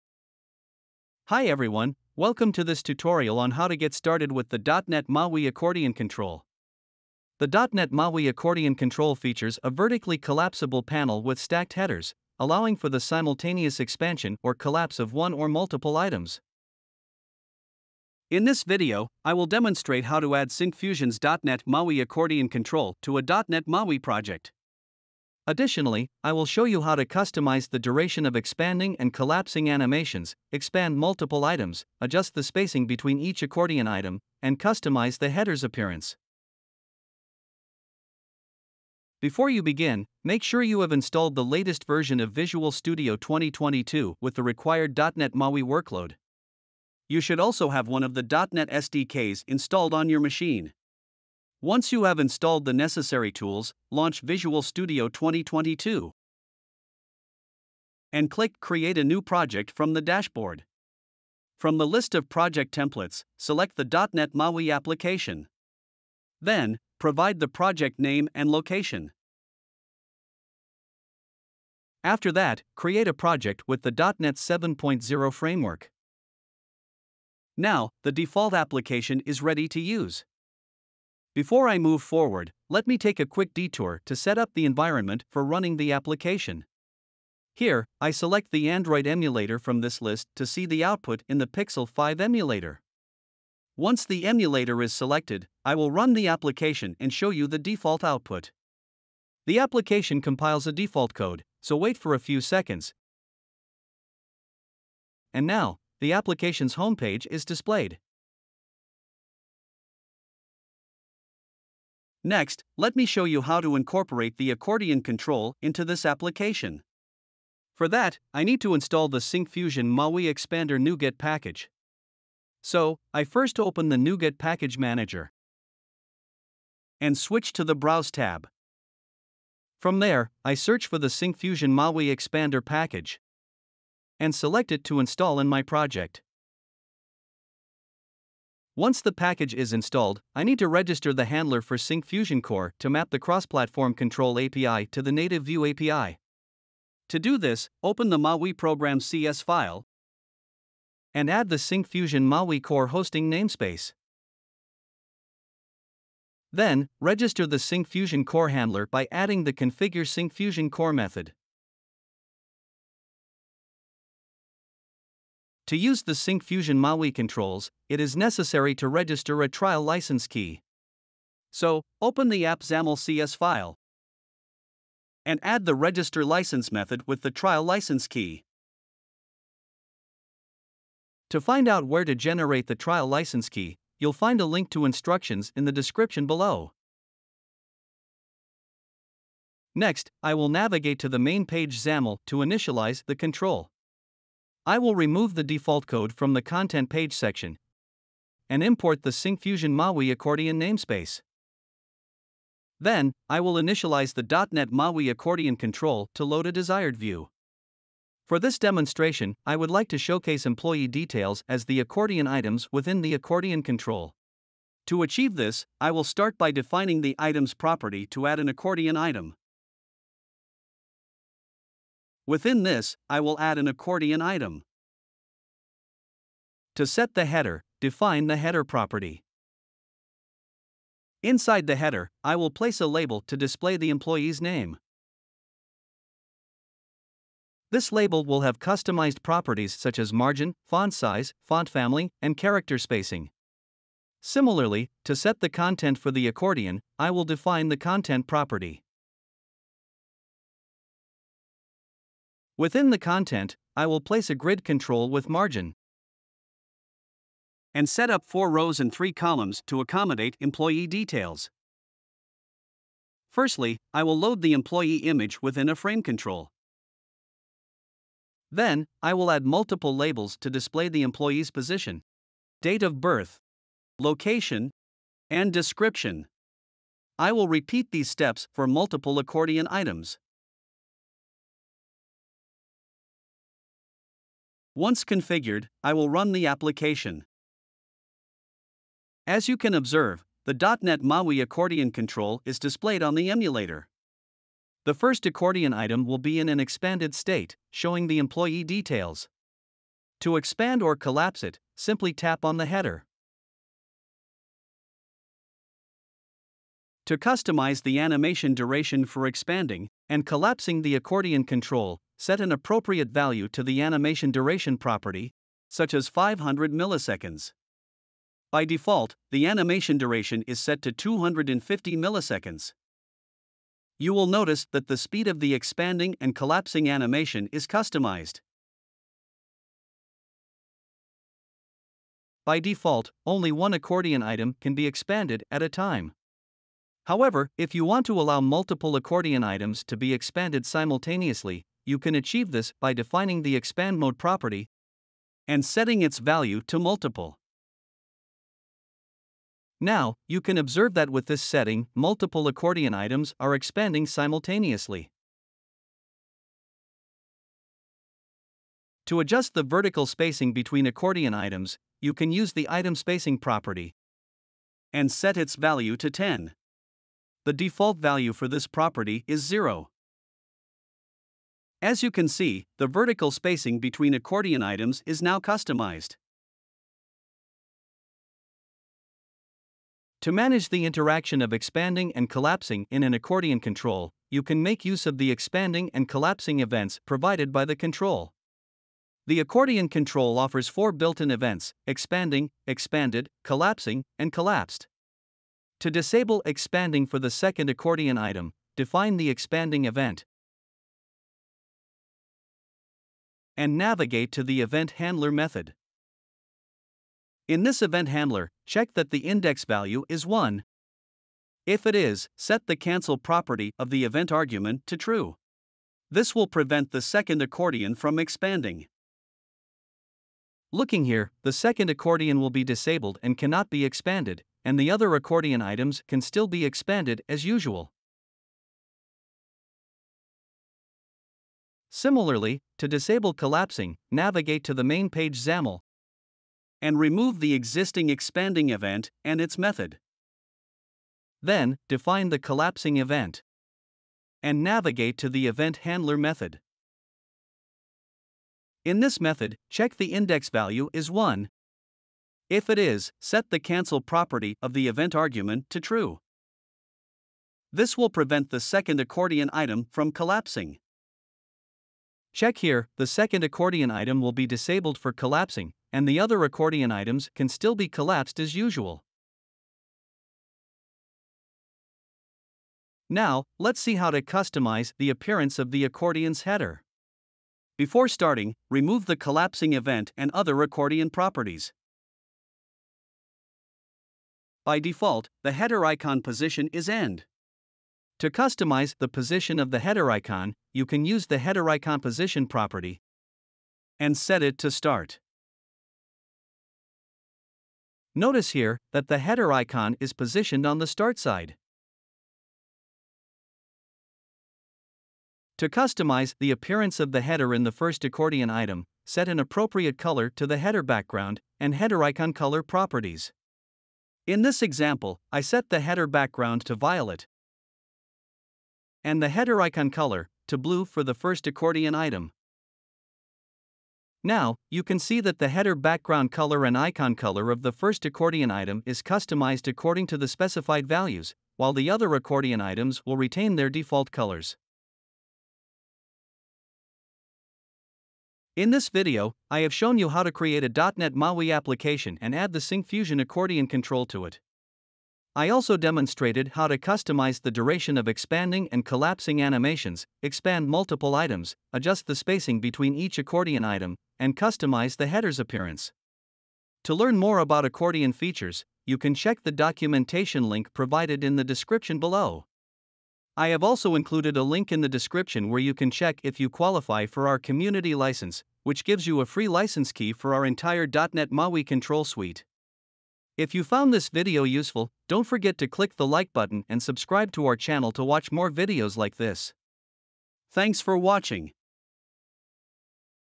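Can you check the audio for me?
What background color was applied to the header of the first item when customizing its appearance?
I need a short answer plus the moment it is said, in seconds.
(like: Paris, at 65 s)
violet, at 516 s.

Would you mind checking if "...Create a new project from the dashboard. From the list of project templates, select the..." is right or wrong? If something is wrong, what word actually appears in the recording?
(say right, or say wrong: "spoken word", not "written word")
right.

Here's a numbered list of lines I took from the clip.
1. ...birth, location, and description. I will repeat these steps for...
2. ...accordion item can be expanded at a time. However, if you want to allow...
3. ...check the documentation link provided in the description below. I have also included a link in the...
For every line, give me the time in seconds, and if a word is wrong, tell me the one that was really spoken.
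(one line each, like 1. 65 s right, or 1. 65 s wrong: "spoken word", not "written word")
1. 272 s right
2. 333 s right
3. 559 s right.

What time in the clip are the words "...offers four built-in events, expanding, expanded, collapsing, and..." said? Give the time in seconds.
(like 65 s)
390 s.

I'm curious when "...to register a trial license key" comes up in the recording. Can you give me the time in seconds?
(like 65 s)
168 s.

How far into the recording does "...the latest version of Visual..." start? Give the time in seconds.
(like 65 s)
41 s.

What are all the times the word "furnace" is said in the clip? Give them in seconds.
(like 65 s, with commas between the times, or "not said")
not said.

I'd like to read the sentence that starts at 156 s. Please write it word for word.
Then, register the Syncfusion Core handler by adding the configure Syncfusion Core method.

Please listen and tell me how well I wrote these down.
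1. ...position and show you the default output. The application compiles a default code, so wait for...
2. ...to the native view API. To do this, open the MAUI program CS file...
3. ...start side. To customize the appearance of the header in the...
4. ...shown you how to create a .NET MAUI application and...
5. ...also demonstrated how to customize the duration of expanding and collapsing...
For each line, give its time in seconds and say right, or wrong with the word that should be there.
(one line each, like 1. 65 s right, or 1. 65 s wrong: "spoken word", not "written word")
1. 96 s wrong: "application", not "position"
2. 144 s right
3. 500 s right
4. 539 s right
5. 545 s right.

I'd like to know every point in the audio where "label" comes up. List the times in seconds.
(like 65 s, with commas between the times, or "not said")
232 s, 237 s, 269 s.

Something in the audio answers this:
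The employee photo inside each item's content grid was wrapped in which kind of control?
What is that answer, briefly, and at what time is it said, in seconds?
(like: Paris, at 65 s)
frame control, at 265 s.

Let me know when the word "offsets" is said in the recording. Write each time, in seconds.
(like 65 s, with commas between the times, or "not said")
not said.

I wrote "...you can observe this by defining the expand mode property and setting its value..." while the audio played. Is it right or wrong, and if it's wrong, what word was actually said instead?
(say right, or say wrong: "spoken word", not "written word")
wrong: "achieve", not "observe".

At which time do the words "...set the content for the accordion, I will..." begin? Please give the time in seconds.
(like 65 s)
245 s.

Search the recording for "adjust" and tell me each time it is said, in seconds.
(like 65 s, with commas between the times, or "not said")
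31 s, 359 s, 551 s.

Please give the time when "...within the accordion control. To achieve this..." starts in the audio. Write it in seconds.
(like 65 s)
212 s.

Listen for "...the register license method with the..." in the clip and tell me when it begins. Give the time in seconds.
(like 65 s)
175 s.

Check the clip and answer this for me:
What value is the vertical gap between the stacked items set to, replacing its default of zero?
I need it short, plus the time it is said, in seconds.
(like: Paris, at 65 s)
10, at 366 s.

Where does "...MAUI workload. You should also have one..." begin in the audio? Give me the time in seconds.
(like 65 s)
45 s.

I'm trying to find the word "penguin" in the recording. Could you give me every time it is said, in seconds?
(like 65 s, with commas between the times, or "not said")
not said.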